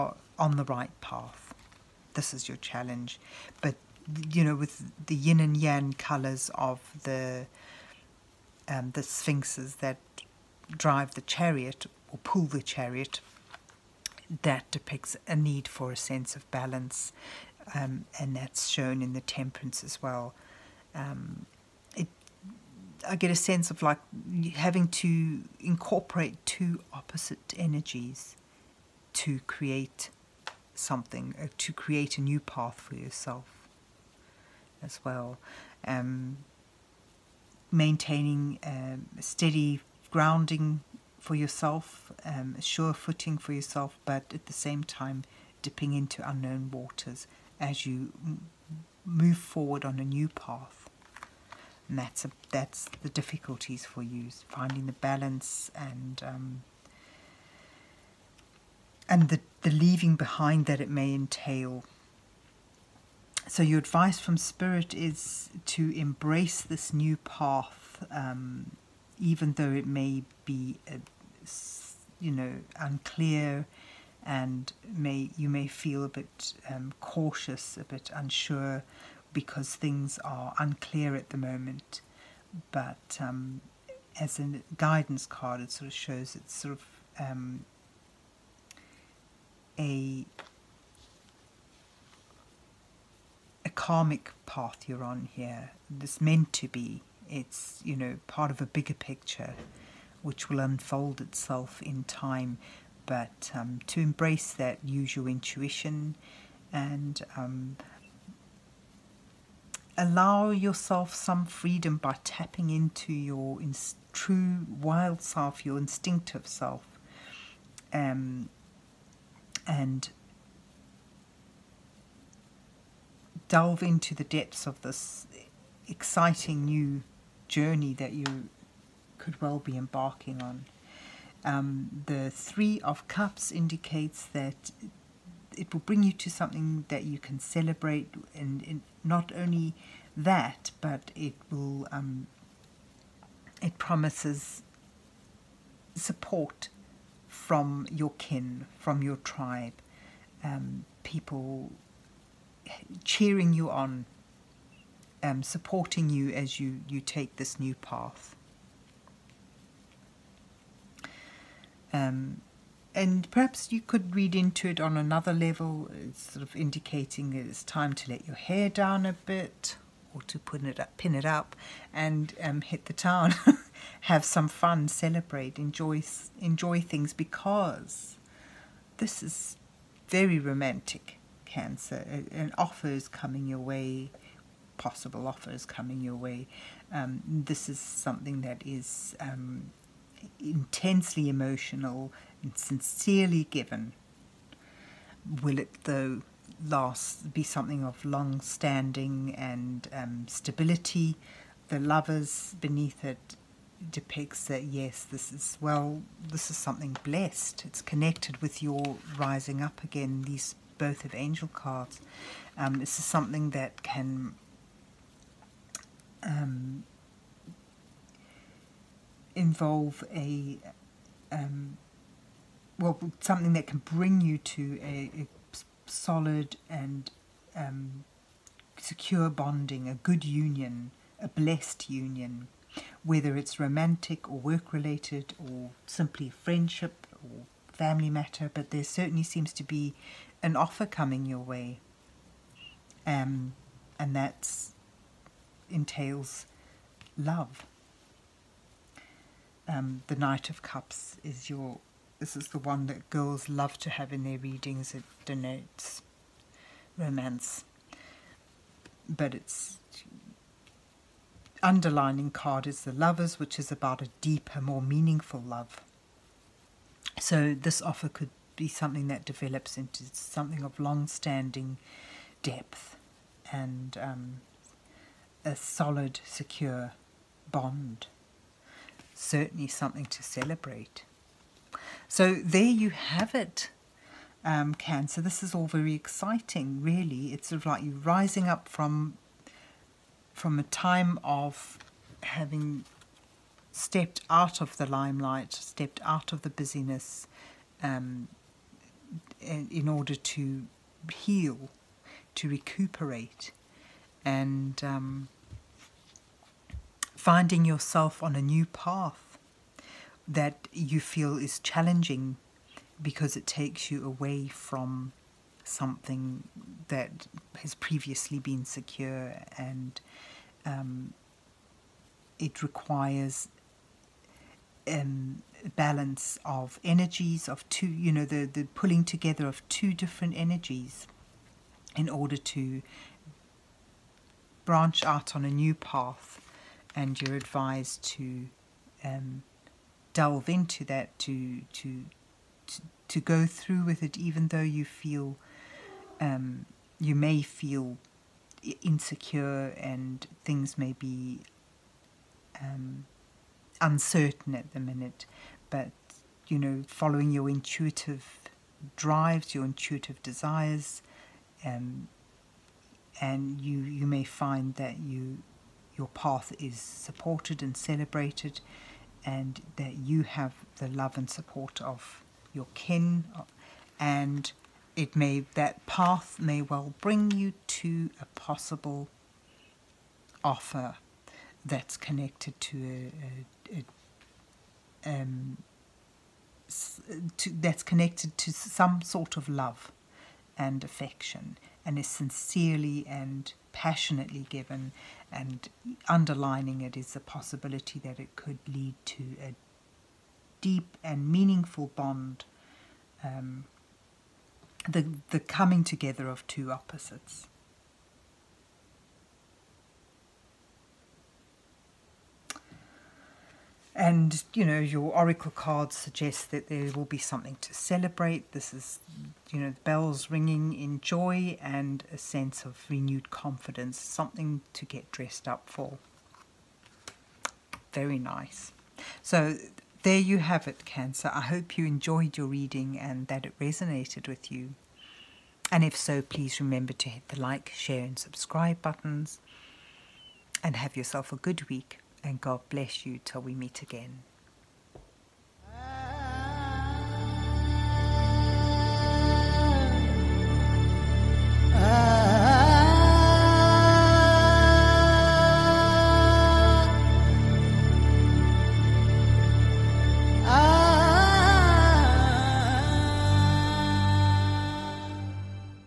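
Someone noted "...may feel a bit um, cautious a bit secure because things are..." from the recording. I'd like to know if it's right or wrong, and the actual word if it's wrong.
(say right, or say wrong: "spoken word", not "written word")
wrong: "unsure", not "secure".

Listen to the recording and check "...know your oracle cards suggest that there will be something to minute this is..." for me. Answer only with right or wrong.
wrong.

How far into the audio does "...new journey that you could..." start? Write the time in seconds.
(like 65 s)
126 s.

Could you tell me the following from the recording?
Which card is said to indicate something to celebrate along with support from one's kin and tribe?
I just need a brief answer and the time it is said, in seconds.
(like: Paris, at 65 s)
Three of Cups, at 132 s.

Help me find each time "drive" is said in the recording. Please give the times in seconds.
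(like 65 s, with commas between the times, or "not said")
10 s, 358 s.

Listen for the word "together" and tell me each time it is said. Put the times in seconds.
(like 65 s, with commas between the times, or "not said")
329 s, 405 s.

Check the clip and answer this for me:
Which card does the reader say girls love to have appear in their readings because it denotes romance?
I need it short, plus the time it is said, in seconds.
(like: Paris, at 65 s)
Knight of Cups, at 250 s.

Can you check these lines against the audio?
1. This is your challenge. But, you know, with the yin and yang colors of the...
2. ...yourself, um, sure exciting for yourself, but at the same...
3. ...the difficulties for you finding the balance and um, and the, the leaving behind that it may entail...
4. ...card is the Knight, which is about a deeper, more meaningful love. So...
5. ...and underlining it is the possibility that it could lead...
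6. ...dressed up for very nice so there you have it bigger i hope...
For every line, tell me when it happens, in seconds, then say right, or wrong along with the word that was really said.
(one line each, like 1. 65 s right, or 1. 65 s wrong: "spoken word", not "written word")
1. 2 s right
2. 41 s wrong: "footing", not "exciting"
3. 53 s right
4. 262 s wrong: "Lovers", not "Knight"
5. 395 s right
6. 425 s wrong: "cancer", not "bigger".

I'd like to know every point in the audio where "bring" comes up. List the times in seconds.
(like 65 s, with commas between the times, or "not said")
135 s, 223 s, 377 s.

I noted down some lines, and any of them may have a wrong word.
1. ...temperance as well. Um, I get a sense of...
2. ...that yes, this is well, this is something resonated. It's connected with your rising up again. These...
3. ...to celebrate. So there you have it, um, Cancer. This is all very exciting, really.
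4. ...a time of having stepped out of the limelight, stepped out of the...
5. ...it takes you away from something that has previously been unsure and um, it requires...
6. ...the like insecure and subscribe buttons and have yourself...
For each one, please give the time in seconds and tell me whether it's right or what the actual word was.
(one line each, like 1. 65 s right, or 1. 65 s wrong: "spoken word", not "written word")
1. 19 s right
2. 204 s wrong: "blessed", not "resonated"
3. 280 s right
4. 290 s right
5. 313 s wrong: "secure", not "unsure"
6. 437 s wrong: "share", not "insecure".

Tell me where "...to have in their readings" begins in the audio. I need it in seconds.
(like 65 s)
253 s.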